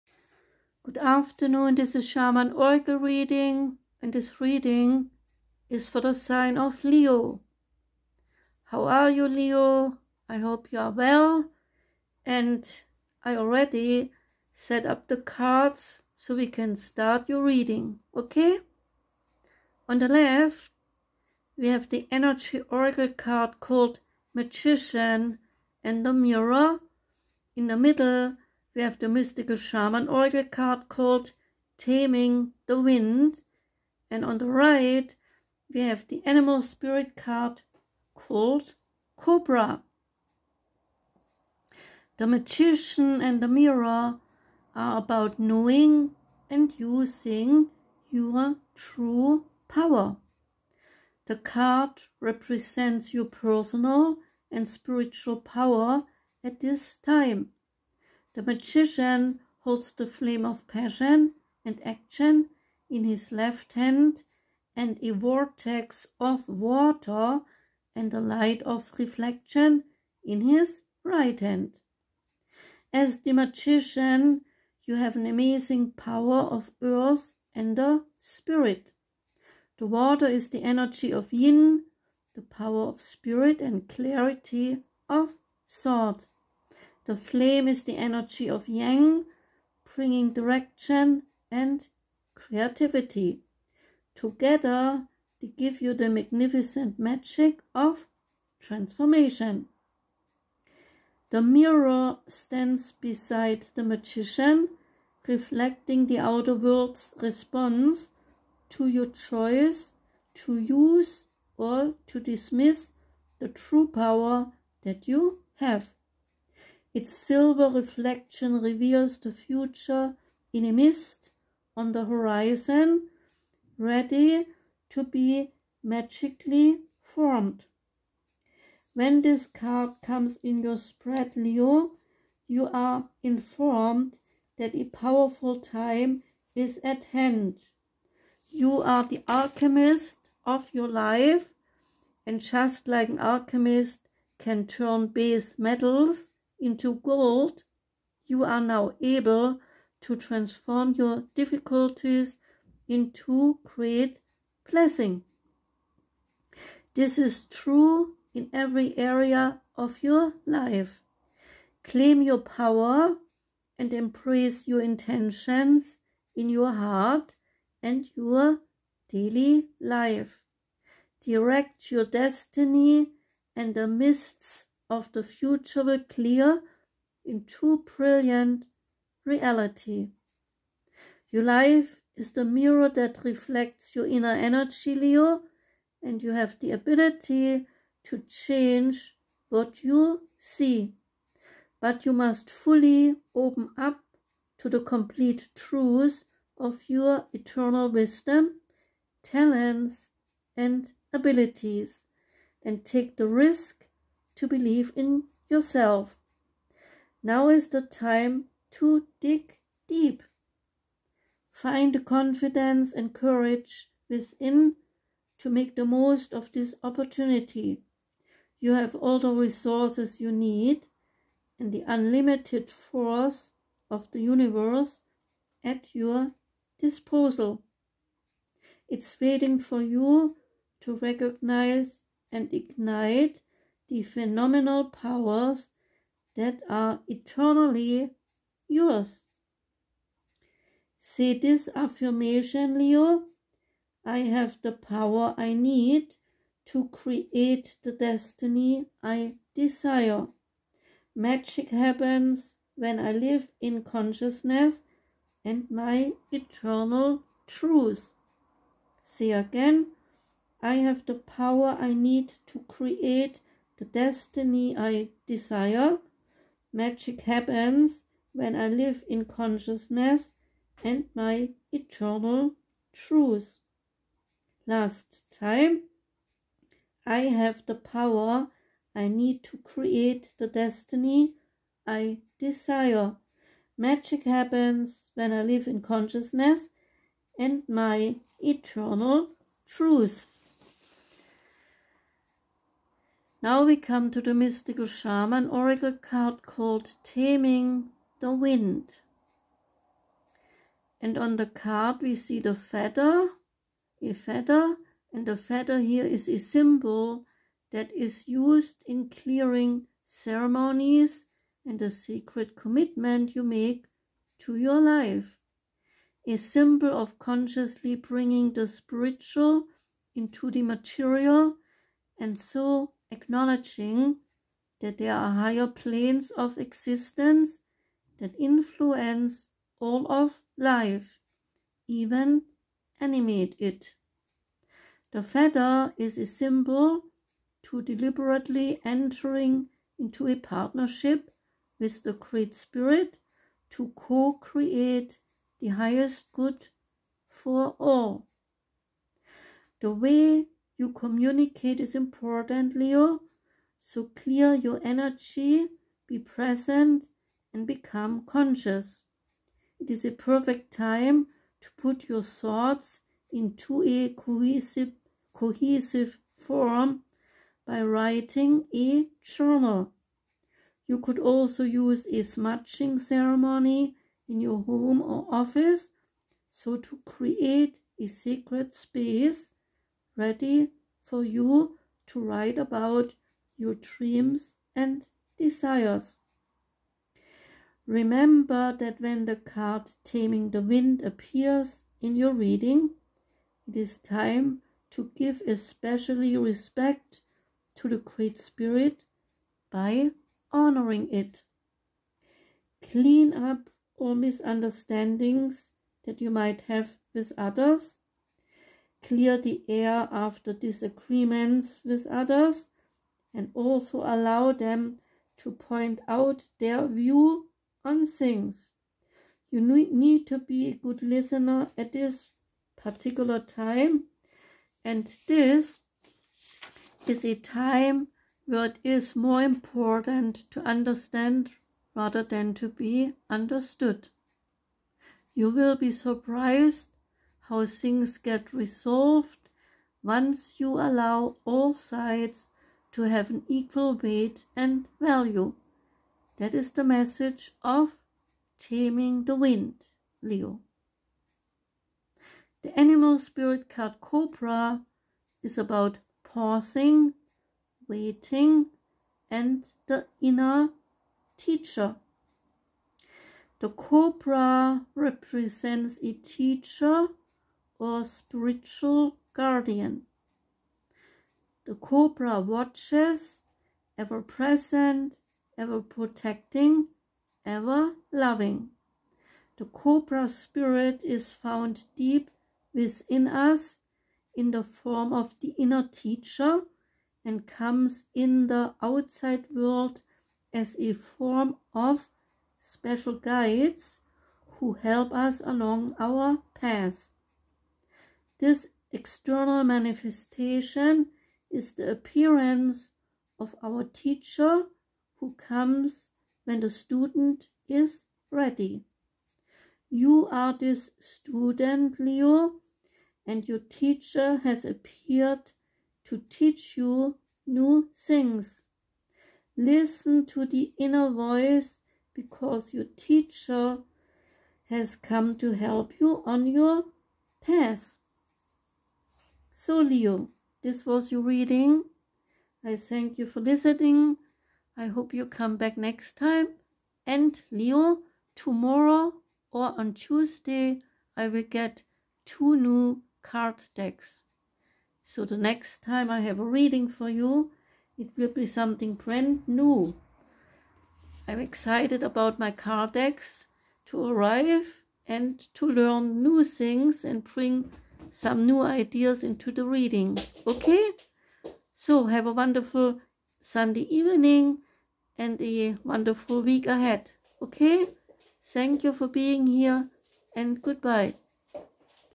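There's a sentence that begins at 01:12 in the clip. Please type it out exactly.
As the magician, you have an amazing power of earth and the spirit.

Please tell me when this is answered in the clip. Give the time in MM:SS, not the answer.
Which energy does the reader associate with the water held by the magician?
01:21.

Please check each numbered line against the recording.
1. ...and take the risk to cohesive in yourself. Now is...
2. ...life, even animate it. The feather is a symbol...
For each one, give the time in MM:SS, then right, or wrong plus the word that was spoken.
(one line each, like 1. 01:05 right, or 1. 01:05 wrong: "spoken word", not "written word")
1. 03:22 wrong: "believe", not "cohesive"
2. 05:30 right.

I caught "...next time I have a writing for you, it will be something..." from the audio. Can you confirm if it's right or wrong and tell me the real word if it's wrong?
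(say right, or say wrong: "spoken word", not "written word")
wrong: "reading", not "writing".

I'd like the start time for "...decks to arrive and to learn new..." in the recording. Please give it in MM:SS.
09:12.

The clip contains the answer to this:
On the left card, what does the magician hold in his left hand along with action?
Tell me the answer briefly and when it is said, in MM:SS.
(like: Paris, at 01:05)
flame of passion, at 01:00.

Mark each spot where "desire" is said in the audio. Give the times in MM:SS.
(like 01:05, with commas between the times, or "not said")
04:09, 04:25, 04:42, 06:25.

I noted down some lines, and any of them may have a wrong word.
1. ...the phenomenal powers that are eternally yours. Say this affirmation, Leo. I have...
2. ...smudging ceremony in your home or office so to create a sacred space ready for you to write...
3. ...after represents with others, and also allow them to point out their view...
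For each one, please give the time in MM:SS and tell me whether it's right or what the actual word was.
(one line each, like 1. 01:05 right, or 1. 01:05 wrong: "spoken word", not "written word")
1. 03:53 right
2. 06:12 right
3. 06:50 wrong: "disagreements", not "represents".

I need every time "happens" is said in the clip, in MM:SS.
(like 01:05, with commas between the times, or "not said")
04:11, 04:27, 04:44.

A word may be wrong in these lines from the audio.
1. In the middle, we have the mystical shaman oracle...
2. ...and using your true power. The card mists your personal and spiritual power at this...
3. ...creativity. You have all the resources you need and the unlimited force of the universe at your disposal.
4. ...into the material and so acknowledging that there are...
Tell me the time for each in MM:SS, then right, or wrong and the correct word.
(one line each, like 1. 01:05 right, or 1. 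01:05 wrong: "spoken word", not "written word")
1. 00:27 right
2. 00:46 wrong: "represents", not "mists"
3. 03:36 wrong: "opportunity", not "creativity"
4. 05:20 right.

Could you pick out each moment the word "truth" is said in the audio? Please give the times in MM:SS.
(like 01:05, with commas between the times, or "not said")
03:15, 04:17, 04:32, 04:49.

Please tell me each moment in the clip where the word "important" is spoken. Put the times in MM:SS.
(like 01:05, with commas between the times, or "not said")
05:51, 07:09.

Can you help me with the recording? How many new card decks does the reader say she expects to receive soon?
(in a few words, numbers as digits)
2.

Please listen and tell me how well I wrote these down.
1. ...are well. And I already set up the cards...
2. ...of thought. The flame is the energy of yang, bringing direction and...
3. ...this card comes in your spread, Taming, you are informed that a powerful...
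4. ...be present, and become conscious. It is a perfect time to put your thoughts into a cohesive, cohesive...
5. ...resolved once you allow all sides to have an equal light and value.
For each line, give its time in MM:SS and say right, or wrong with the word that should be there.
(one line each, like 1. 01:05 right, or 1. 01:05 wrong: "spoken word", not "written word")
1. 00:10 right
2. 01:25 right
3. 02:09 wrong: "Leo", not "Taming"
4. 05:56 right
5. 07:18 wrong: "weight", not "light".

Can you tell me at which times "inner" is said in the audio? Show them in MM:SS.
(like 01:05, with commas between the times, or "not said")
03:04, 07:40, 08:05, 08:40.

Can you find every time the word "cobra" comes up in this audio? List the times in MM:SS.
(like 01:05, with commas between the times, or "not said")
00:39, 07:33, 07:43, 07:51, 07:59.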